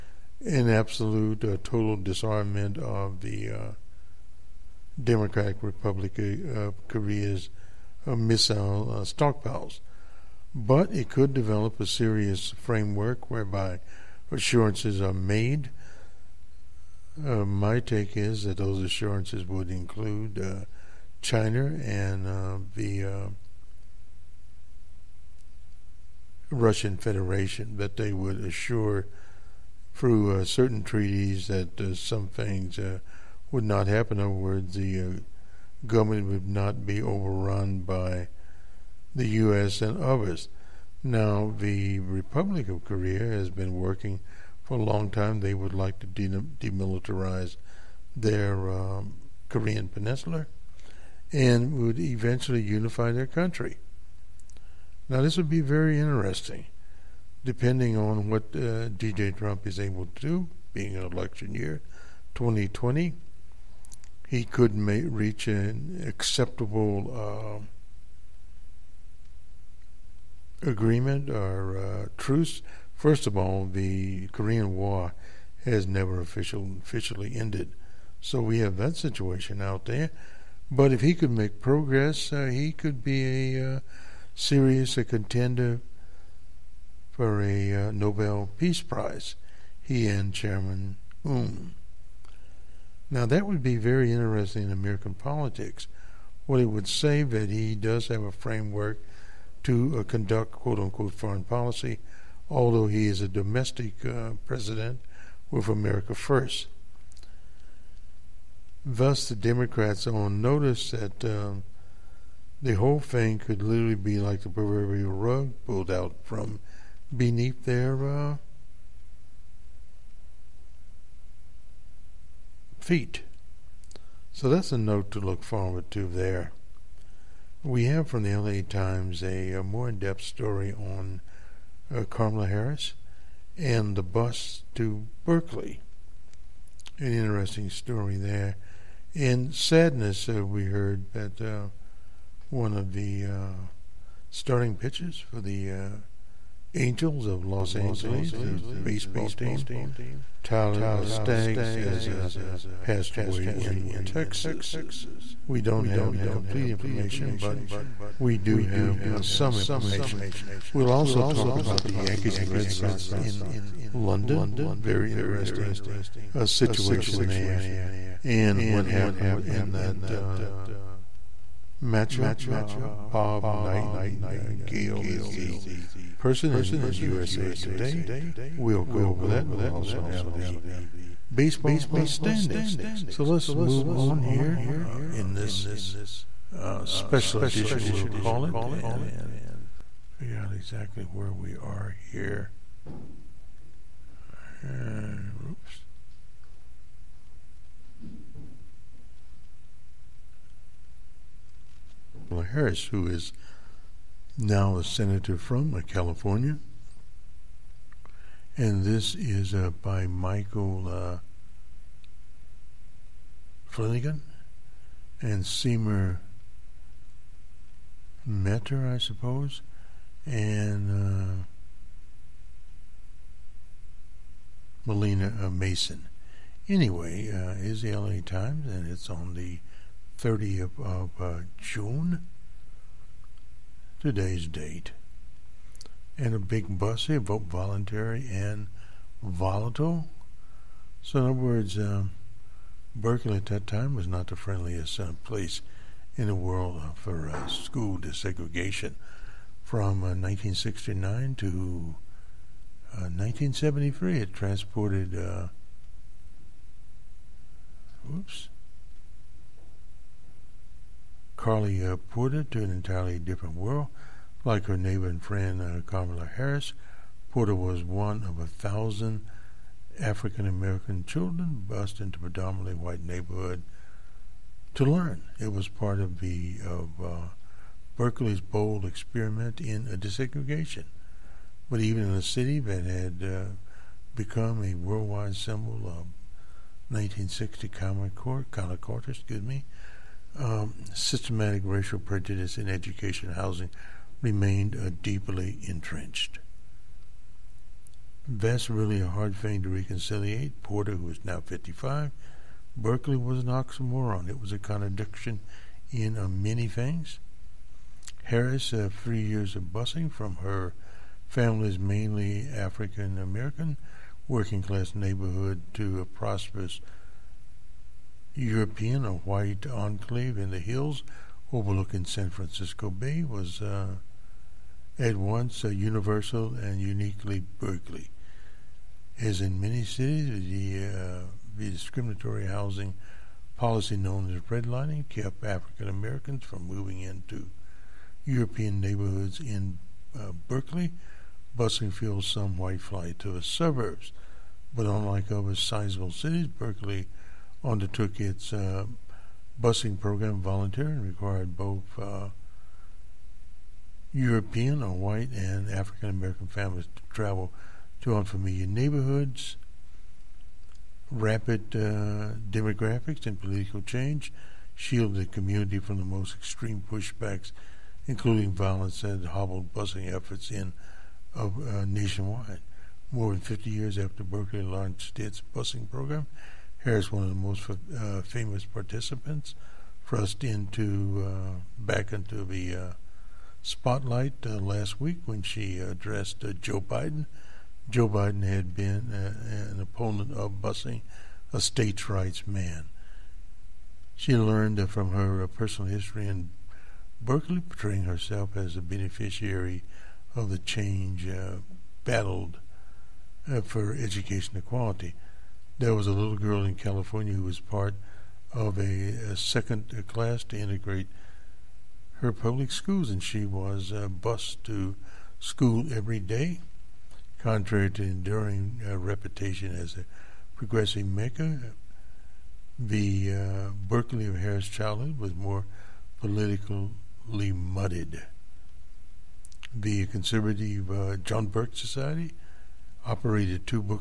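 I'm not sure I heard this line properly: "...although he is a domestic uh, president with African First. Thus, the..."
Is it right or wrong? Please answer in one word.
wrong.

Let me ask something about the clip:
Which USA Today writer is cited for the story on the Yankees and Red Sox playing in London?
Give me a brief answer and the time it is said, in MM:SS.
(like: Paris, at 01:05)
Bob Nightingale, at 02:52.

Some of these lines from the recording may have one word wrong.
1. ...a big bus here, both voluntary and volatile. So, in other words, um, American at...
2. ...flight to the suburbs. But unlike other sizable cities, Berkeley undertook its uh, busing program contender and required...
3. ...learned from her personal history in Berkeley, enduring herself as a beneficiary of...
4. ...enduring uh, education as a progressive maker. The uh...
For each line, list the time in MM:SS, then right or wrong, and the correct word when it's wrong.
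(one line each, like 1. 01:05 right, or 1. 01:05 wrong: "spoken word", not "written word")
1. 03:56 wrong: "Berkeley", not "American"
2. 05:42 wrong: "volunteer", not "contender"
3. 06:34 wrong: "portraying", not "enduring"
4. 06:58 wrong: "reputation", not "education".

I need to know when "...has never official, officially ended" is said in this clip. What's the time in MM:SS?
01:15.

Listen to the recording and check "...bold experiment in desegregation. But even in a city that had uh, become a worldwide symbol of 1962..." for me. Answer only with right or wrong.
wrong.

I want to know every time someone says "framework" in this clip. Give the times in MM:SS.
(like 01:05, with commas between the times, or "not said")
00:12, 01:38.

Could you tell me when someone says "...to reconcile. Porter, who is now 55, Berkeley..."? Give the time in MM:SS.
04:59.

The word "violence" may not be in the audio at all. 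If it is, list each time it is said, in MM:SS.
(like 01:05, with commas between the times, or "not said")
06:08.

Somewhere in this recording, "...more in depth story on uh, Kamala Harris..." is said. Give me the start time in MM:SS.
02:09.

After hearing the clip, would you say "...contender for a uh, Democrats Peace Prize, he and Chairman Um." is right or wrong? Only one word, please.
wrong.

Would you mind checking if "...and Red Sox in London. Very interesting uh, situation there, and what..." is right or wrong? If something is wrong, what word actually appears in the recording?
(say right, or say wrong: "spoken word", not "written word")
right.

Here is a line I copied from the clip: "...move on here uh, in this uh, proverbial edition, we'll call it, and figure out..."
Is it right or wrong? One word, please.
wrong.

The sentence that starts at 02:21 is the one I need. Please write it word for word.
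Uh, one of the uh, starting pitchers for the uh, Angels of Los Angeles, the baseball team.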